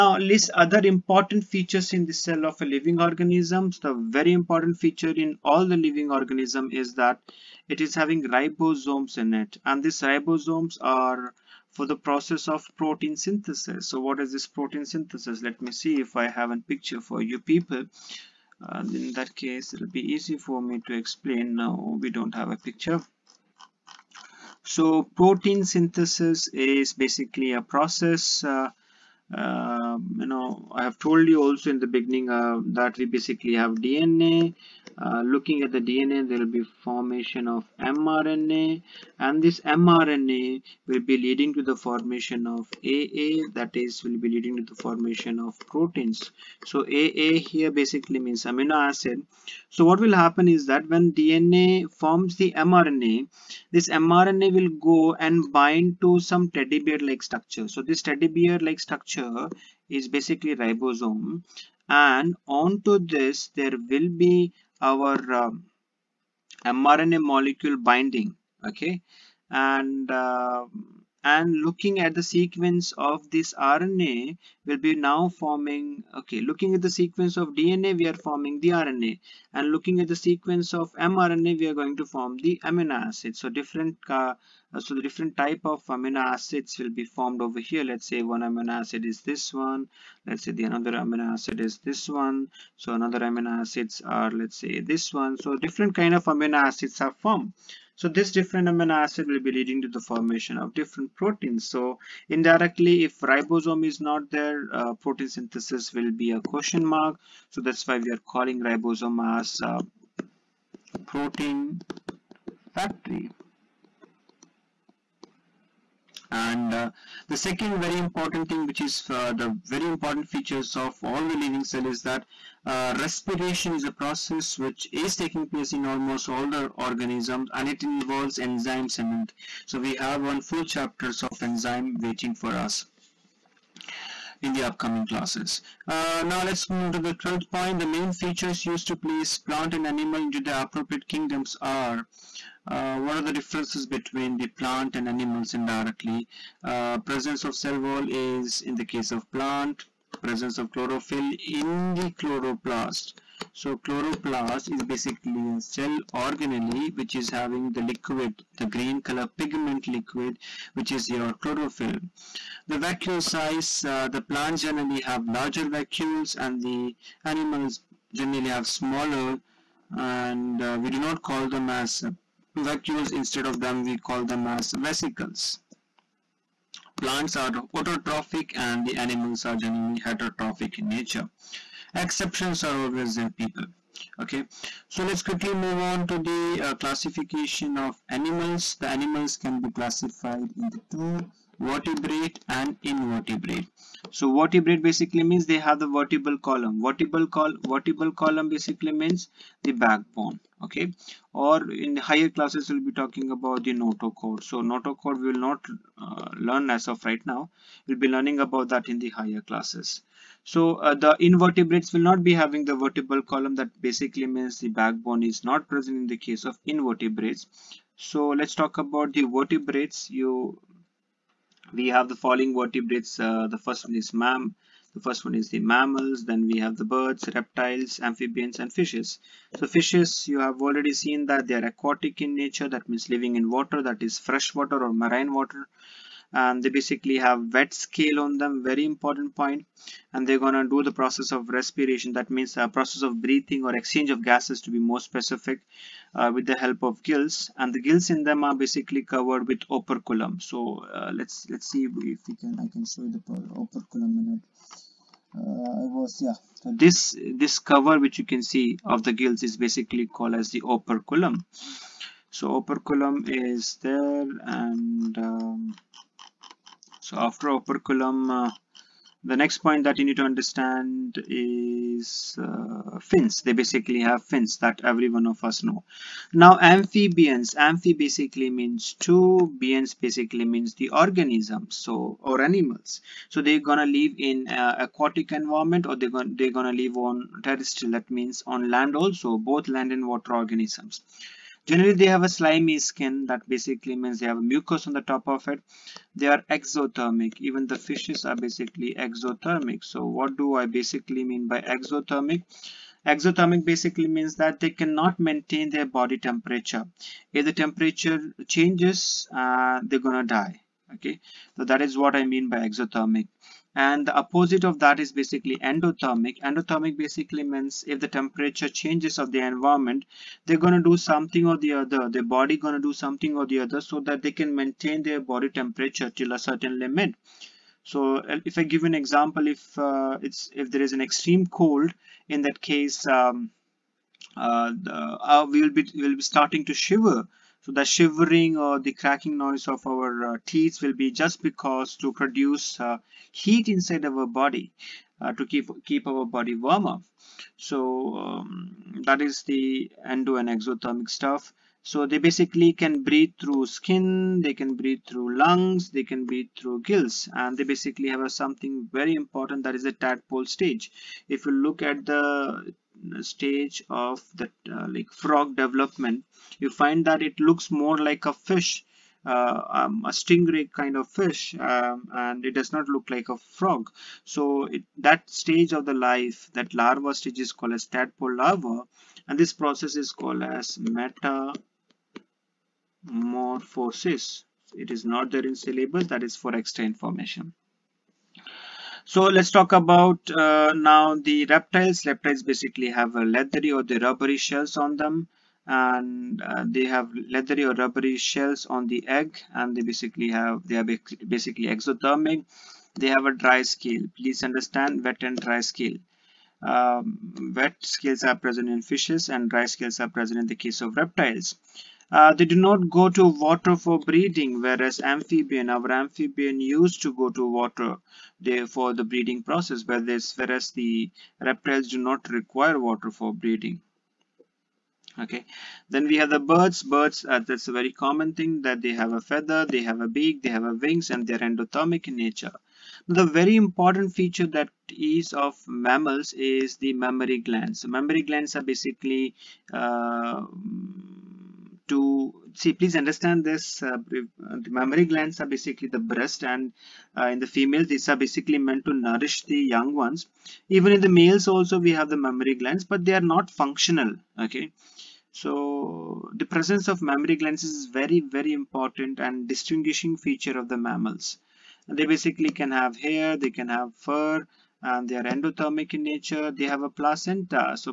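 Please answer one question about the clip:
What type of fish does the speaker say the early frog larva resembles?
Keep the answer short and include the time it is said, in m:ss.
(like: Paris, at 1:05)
Stingray, at 6:10.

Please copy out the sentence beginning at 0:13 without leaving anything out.
So what is this protein synthesis?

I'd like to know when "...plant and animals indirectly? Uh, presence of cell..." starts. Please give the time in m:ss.
2:24.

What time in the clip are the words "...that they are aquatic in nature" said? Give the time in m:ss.
3:51.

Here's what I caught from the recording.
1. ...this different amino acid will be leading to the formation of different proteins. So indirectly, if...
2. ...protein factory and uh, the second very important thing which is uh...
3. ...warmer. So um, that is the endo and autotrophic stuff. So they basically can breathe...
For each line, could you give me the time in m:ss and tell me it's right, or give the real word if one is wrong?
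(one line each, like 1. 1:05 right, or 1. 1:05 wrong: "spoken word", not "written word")
1. 1:38 right
2. 1:51 right
3. 5:46 wrong: "exothermic", not "autotrophic".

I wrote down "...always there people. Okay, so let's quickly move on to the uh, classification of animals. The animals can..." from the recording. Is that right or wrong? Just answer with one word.
right.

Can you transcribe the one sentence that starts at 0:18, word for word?
Uh, in that case, it'll be easy for me to explain now.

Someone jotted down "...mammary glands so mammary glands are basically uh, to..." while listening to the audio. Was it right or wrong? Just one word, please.
right.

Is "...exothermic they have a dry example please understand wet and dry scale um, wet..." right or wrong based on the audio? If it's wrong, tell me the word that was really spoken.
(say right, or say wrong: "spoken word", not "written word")
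wrong: "scale", not "example".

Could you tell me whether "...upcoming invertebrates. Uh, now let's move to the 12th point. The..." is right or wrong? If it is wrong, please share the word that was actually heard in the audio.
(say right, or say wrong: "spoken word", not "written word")
wrong: "classes", not "invertebrates".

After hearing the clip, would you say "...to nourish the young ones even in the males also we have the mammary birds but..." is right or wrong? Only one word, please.
wrong.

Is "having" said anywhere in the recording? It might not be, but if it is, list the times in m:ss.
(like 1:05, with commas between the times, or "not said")
0:07, 2:37, 3:32.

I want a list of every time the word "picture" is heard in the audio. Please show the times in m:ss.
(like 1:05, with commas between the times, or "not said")
0:16, 0:22.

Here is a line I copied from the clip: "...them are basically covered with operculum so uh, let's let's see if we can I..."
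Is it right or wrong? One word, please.
right.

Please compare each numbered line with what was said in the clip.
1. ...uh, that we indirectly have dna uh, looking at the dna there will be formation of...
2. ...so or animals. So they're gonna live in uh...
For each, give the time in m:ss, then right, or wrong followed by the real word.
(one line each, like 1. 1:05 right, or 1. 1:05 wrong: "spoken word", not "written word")
1. 0:32 wrong: "basically", not "indirectly"
2. 4:41 right.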